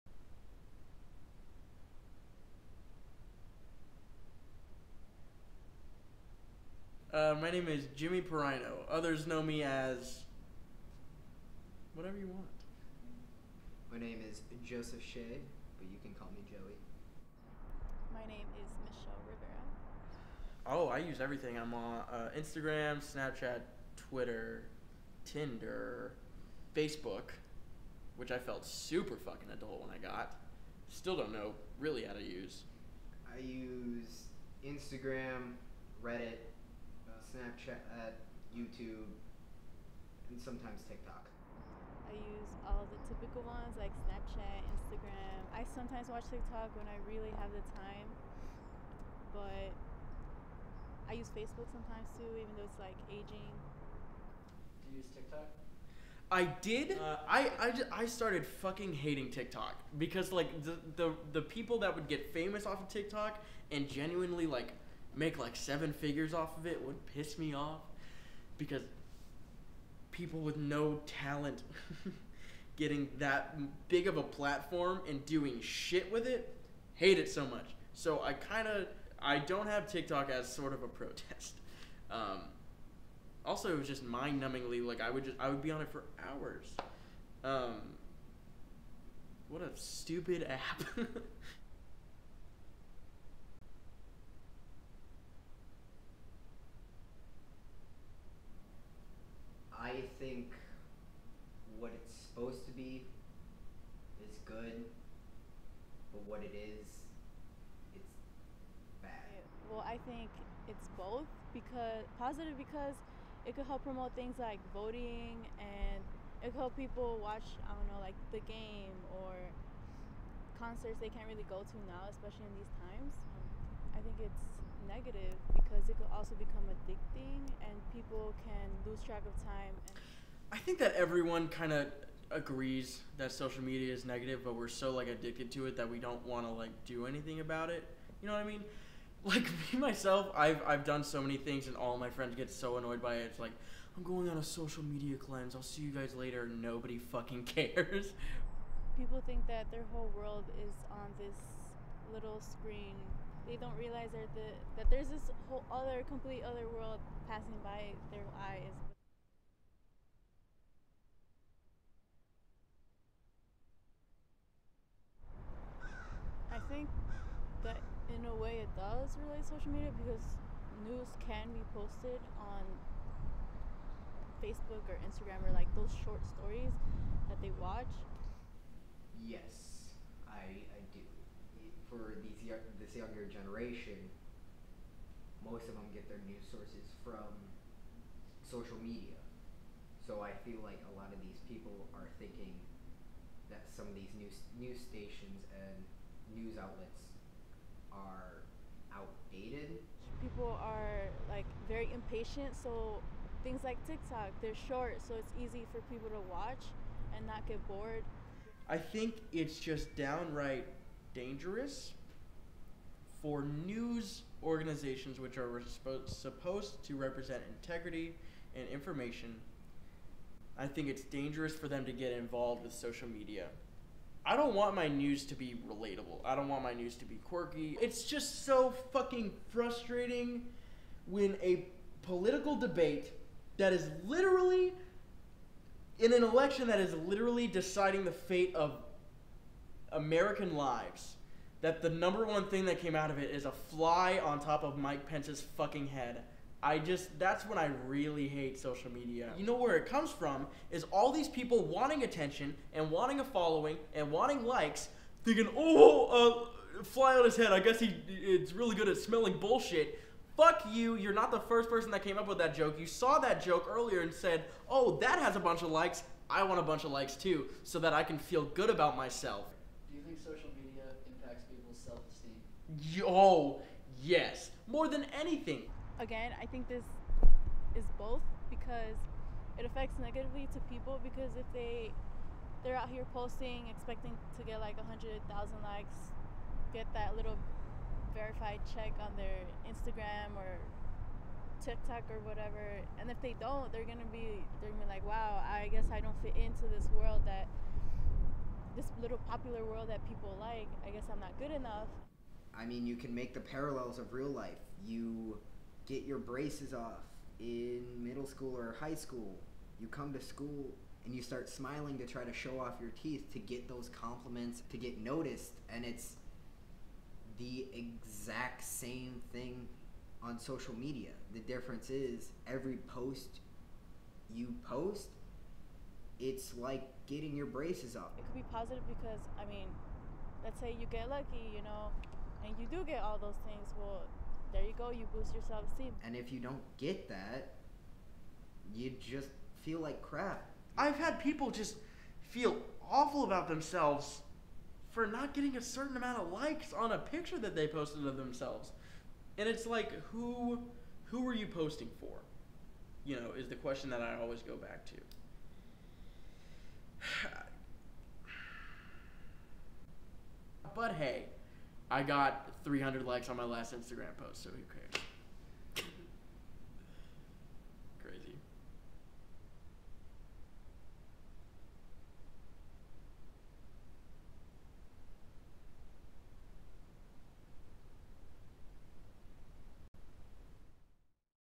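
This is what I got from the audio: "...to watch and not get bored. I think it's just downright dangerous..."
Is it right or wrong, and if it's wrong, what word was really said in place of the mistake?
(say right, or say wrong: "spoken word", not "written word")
right.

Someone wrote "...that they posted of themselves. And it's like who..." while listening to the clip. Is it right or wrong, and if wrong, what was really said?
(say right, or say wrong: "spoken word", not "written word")
right.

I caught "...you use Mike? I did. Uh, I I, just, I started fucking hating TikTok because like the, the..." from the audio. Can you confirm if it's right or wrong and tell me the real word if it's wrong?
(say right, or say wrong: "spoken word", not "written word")
wrong: "TikTok", not "Mike".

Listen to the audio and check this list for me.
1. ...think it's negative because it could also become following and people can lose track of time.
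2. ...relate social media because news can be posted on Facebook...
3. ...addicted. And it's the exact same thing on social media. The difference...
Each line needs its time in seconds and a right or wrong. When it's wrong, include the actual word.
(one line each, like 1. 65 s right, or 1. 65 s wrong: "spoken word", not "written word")
1. 124 s wrong: "addicting", not "following"
2. 169 s right
3. 315 s wrong: "noticed", not "addicted".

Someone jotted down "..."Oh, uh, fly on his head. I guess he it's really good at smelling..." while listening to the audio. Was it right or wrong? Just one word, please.
right.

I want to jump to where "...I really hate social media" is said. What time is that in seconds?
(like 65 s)
247 s.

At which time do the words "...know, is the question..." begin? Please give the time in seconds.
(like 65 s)
353 s.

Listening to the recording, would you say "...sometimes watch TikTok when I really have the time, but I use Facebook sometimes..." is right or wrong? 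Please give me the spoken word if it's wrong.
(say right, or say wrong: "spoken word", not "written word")
right.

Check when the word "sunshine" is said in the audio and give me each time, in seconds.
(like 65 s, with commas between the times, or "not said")
not said.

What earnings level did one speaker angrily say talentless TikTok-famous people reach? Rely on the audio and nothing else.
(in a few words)
seven figures.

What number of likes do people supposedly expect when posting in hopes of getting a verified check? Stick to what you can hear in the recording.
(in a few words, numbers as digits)
100,000.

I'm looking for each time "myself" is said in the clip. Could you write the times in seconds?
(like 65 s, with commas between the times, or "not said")
139 s, 268 s.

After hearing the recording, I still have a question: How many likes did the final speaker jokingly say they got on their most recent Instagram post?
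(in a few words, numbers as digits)
300.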